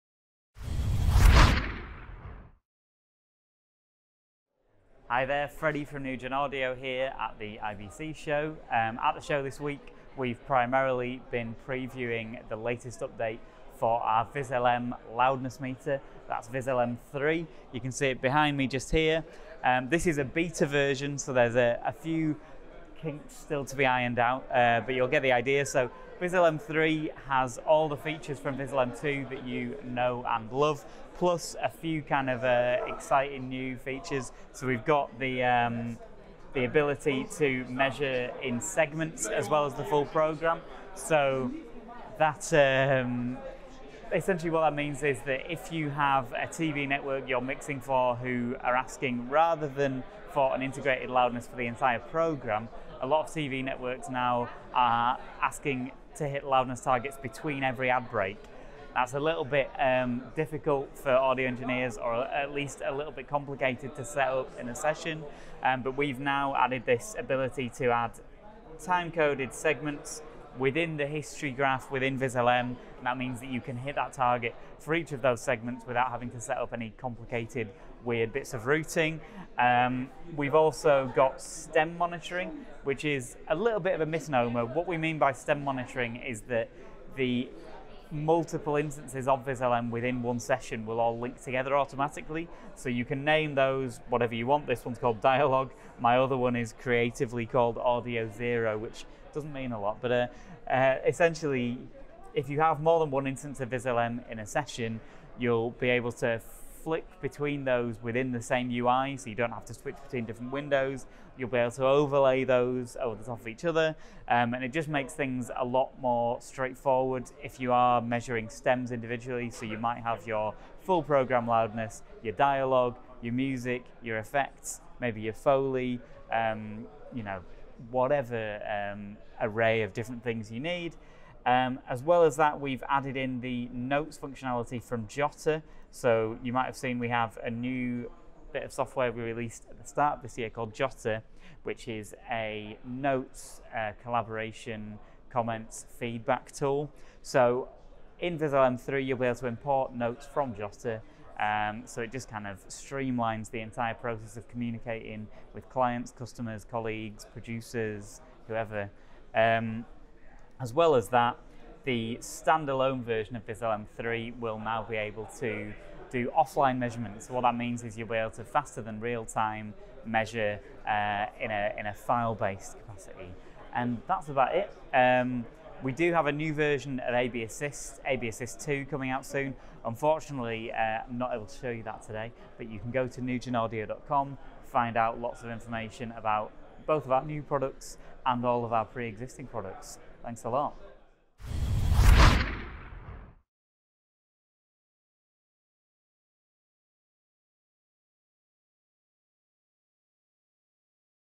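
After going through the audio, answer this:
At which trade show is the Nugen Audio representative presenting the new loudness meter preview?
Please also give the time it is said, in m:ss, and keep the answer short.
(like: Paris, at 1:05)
IBC, at 0:07.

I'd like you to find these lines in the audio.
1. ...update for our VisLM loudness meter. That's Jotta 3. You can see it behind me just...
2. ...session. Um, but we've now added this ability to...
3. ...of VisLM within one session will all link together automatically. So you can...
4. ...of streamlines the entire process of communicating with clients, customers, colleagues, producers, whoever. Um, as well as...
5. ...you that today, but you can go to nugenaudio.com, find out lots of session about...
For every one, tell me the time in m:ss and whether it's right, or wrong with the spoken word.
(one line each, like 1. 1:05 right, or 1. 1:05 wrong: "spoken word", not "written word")
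1. 0:13 wrong: "VisLM", not "Jotta"
2. 1:04 right
3. 1:29 right
4. 2:32 right
5. 3:01 wrong: "information", not "session".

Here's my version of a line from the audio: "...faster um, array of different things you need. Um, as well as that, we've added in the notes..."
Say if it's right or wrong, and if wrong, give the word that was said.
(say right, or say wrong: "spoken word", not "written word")
wrong: "whatever", not "faster".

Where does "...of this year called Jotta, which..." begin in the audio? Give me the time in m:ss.
2:20.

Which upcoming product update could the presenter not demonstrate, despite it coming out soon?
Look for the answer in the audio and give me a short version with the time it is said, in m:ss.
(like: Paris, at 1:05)
AB Assist 2, at 2:58.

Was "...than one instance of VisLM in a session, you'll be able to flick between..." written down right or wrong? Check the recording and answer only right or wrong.
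right.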